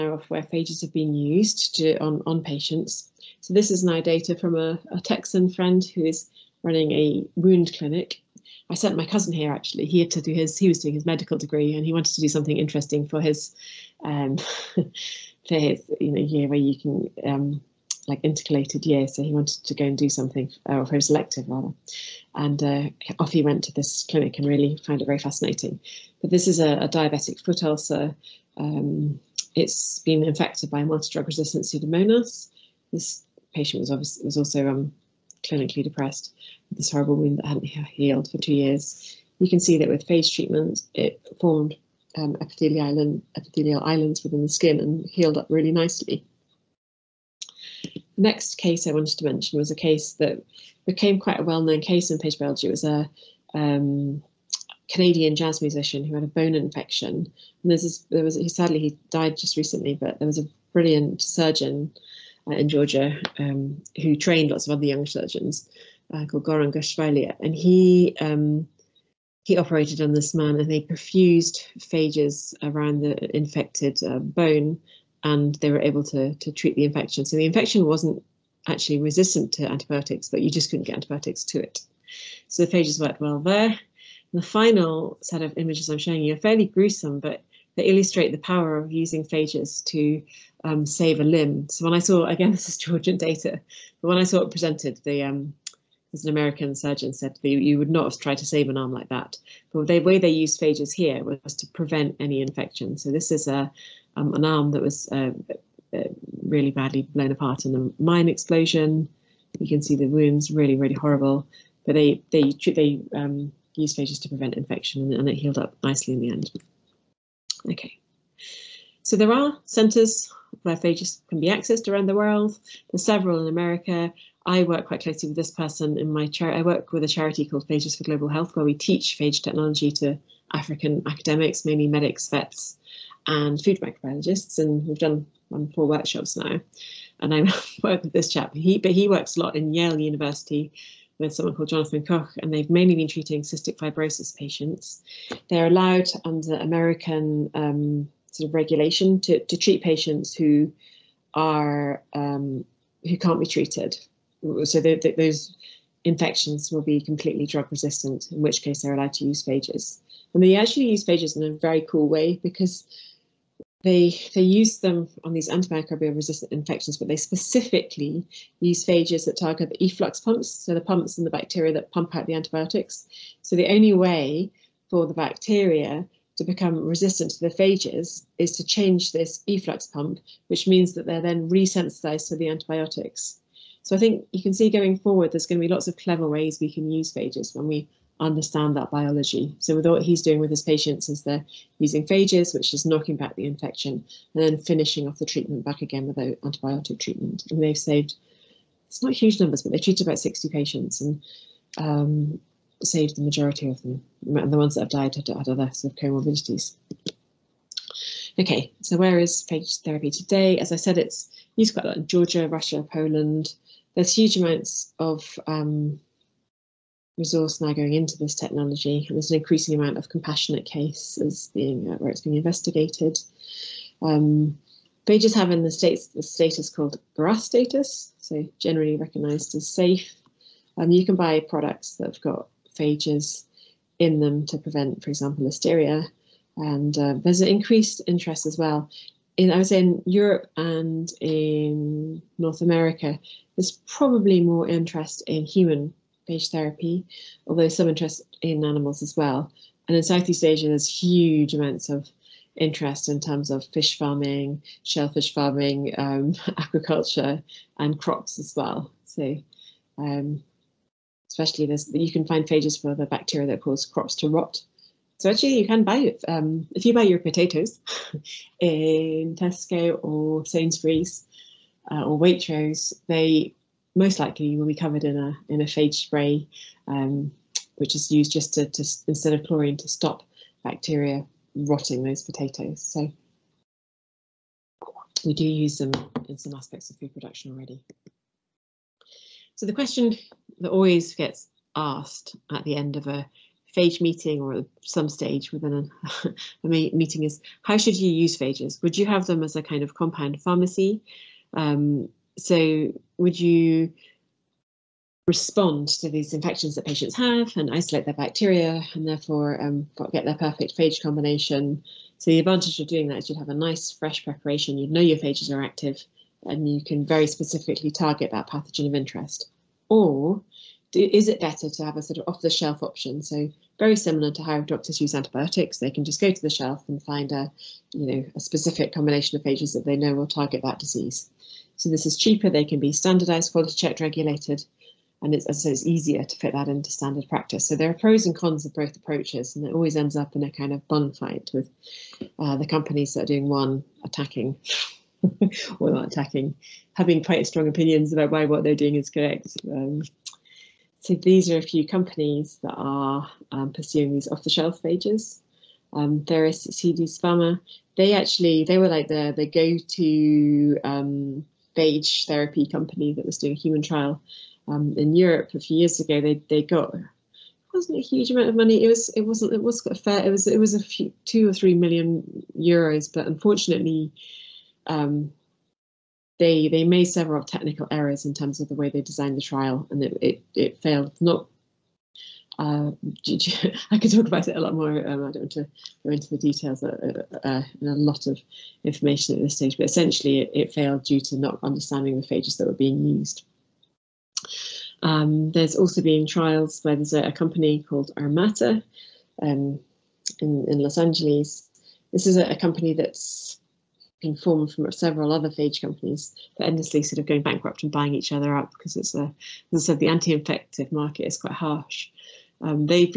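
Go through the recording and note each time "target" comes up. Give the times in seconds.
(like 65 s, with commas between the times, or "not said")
169 s, 317 s, 330 s.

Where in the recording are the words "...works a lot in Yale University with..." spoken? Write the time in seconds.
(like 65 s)
139 s.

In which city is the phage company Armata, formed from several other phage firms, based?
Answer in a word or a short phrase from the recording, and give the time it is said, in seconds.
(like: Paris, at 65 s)
Los Angeles, at 400 s.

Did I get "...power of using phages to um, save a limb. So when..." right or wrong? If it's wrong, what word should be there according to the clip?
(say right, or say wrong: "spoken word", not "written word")
right.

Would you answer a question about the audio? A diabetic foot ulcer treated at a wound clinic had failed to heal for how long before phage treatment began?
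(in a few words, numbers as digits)
2 years.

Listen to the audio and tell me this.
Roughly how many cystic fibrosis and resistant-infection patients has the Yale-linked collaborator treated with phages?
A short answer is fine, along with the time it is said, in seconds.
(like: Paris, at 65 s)
60, at 200 s.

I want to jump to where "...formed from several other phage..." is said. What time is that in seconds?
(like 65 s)
404 s.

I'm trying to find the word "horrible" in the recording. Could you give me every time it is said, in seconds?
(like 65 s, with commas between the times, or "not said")
36 s, 110 s.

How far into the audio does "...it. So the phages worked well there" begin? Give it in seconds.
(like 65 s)
81 s.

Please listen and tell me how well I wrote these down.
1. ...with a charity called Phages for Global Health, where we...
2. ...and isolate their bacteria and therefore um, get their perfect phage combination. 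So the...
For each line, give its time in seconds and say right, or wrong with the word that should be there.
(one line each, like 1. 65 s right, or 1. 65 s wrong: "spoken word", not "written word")
1. 126 s right
2. 307 s right.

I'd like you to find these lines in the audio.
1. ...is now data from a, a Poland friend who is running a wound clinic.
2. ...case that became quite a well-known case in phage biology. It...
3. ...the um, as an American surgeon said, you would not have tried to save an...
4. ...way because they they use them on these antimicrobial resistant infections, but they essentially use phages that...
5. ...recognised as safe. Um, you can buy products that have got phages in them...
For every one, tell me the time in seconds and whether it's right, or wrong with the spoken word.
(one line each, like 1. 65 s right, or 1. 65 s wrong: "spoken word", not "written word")
1. 3 s wrong: "Texan", not "Poland"
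2. 49 s right
3. 95 s right
4. 162 s wrong: "specifically", not "essentially"
5. 228 s right.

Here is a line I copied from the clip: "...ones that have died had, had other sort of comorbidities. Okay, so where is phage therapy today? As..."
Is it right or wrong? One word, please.
right.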